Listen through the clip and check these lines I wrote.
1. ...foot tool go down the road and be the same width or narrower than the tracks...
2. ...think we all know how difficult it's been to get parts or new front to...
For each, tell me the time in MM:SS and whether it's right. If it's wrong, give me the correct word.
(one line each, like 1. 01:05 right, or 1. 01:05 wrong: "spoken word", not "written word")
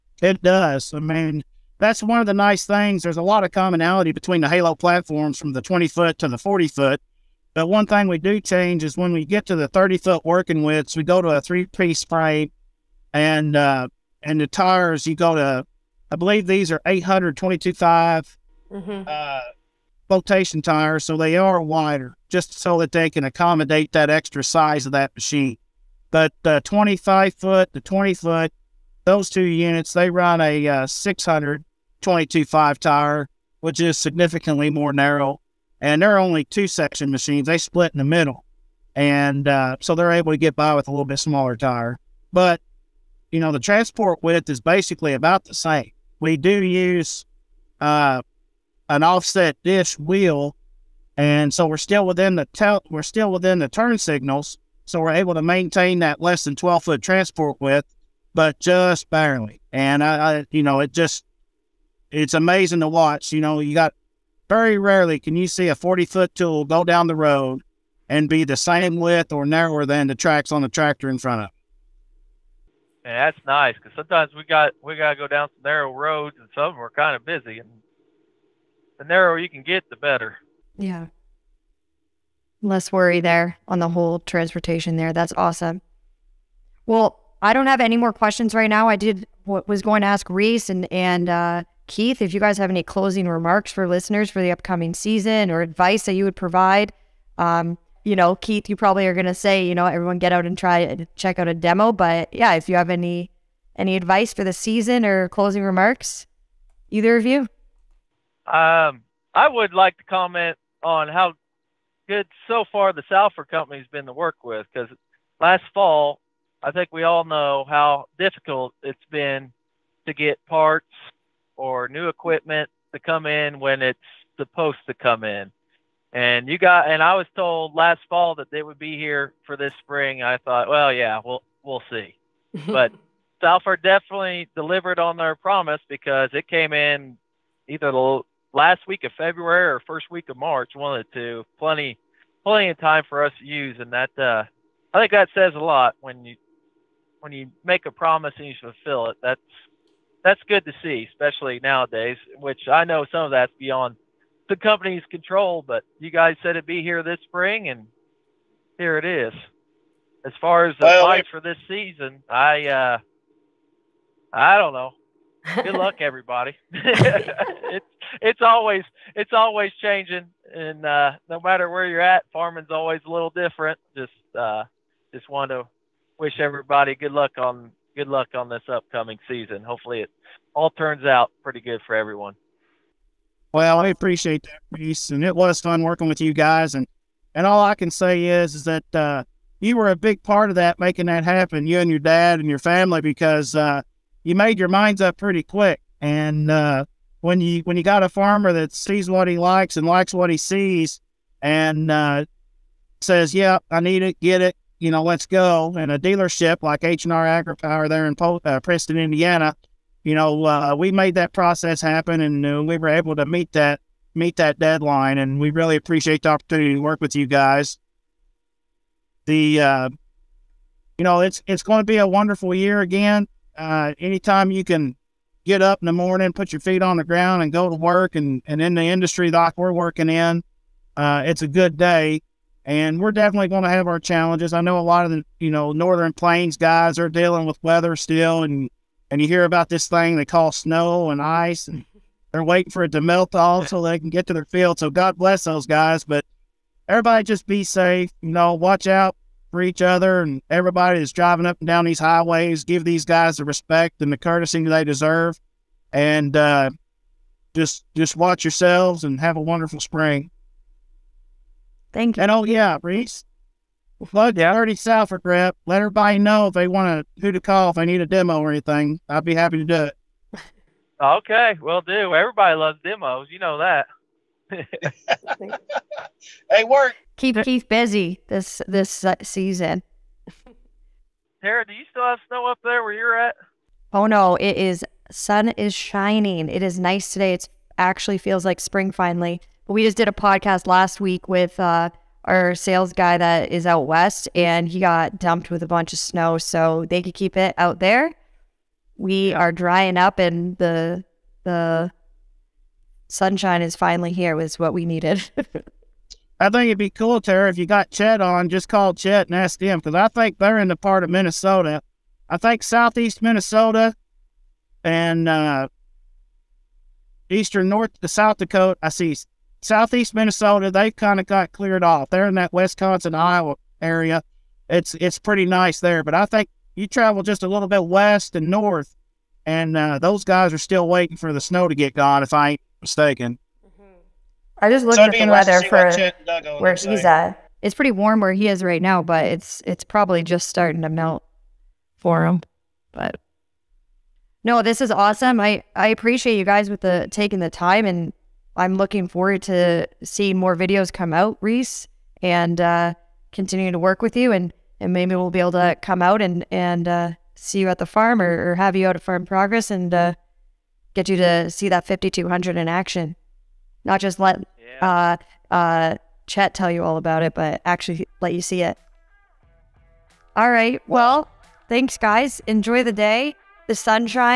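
1. 01:06 right
2. 01:56 wrong: "equipment", not "front".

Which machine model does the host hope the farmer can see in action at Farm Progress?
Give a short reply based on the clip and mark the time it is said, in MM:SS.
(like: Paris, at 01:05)
5200, at 06:01.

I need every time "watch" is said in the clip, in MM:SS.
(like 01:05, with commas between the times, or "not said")
01:02, 04:08, 04:18.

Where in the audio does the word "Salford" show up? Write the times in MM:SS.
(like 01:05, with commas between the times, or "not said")
01:53, 02:13, 04:24.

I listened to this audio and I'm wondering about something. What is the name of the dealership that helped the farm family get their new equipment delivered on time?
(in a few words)
H&R AgriPower.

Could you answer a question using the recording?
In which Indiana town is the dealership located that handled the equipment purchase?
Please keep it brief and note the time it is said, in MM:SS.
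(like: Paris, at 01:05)
Preston, at 03:28.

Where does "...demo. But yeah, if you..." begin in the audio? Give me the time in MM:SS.
01:41.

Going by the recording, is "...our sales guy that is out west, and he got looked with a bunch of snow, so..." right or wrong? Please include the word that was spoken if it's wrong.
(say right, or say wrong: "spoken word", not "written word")
wrong: "dumped", not "looked".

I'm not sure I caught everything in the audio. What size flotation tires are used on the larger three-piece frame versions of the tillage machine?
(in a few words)
822.5 mm.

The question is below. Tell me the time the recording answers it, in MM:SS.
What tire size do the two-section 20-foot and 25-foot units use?
00:30.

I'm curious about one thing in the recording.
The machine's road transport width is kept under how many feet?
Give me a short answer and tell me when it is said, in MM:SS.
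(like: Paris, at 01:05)
12 foot, at 00:56.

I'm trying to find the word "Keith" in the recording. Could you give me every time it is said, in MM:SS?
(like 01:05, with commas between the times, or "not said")
01:31, 01:38, 04:37.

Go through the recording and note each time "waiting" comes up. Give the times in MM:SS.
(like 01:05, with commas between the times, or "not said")
04:02, 05:30.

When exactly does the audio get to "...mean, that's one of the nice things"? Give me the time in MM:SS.
00:00.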